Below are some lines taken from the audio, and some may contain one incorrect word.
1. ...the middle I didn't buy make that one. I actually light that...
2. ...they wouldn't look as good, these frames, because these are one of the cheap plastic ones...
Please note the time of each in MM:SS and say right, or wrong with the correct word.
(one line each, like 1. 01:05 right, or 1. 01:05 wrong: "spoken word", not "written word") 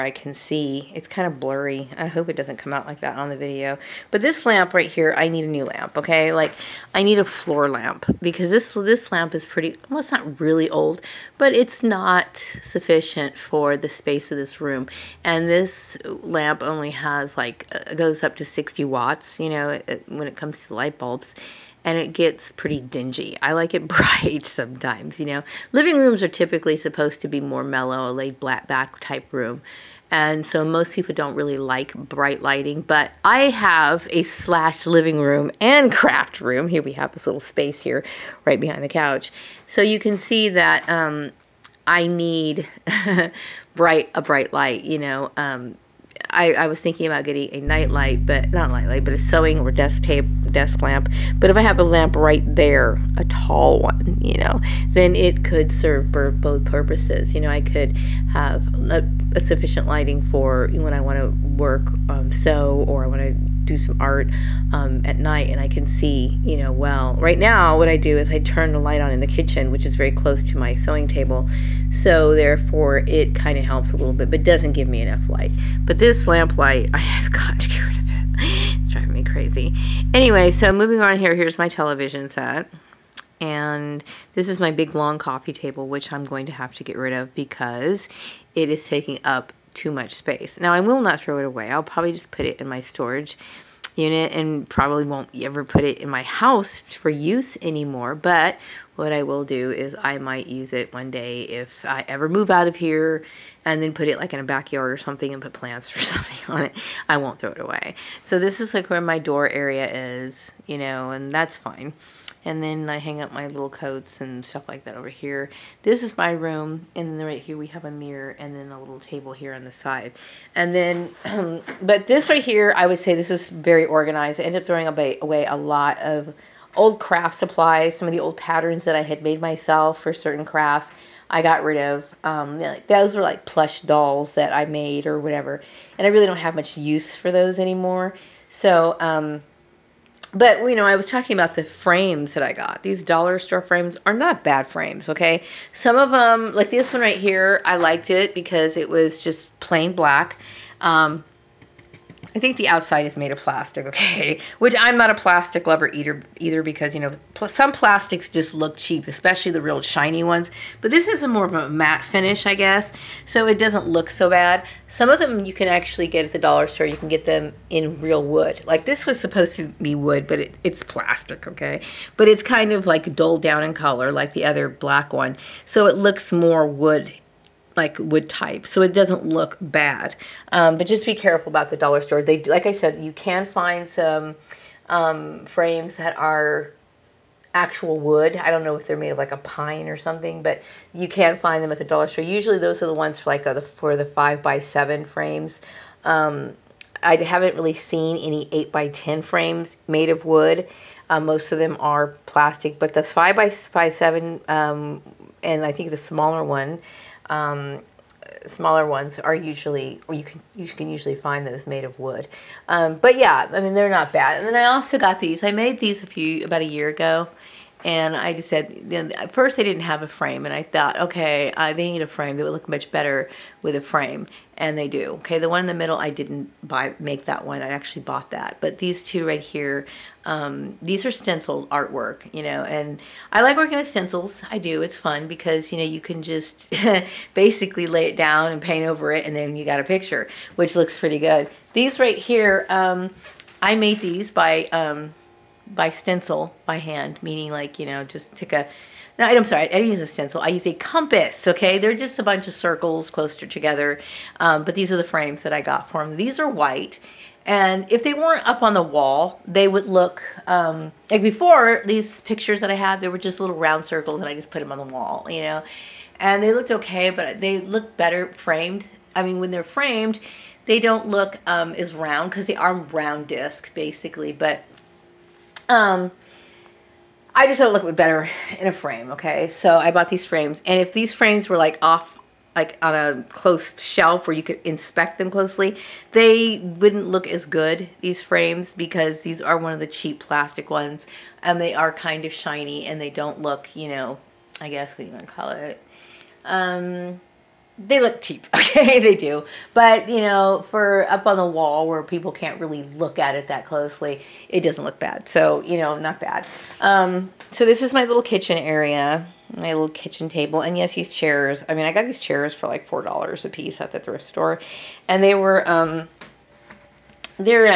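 1. 03:45 wrong: "bought", not "light"
2. 04:46 right.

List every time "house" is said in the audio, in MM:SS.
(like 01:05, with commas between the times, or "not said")
01:36.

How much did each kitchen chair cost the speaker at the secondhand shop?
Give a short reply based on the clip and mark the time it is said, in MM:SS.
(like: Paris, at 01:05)
$4, at 05:12.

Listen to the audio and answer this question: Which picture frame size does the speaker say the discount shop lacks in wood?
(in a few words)
8 by 10.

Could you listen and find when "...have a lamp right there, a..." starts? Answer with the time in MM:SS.
00:51.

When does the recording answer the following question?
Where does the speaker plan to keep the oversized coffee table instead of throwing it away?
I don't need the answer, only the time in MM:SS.
01:32.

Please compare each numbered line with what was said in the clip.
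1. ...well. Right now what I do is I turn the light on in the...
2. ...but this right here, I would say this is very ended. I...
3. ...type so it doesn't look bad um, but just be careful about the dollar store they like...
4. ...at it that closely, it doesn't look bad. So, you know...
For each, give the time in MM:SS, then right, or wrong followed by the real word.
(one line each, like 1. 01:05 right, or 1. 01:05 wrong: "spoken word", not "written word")
1. 01:06 right
2. 02:01 wrong: "organized", not "ended"
3. 02:58 right
4. 05:03 right.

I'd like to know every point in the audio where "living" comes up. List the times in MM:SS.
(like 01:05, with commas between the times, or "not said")
00:25, 00:34.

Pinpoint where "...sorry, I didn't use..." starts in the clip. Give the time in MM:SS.
04:09.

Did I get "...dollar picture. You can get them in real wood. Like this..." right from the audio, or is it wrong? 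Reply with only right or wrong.
wrong.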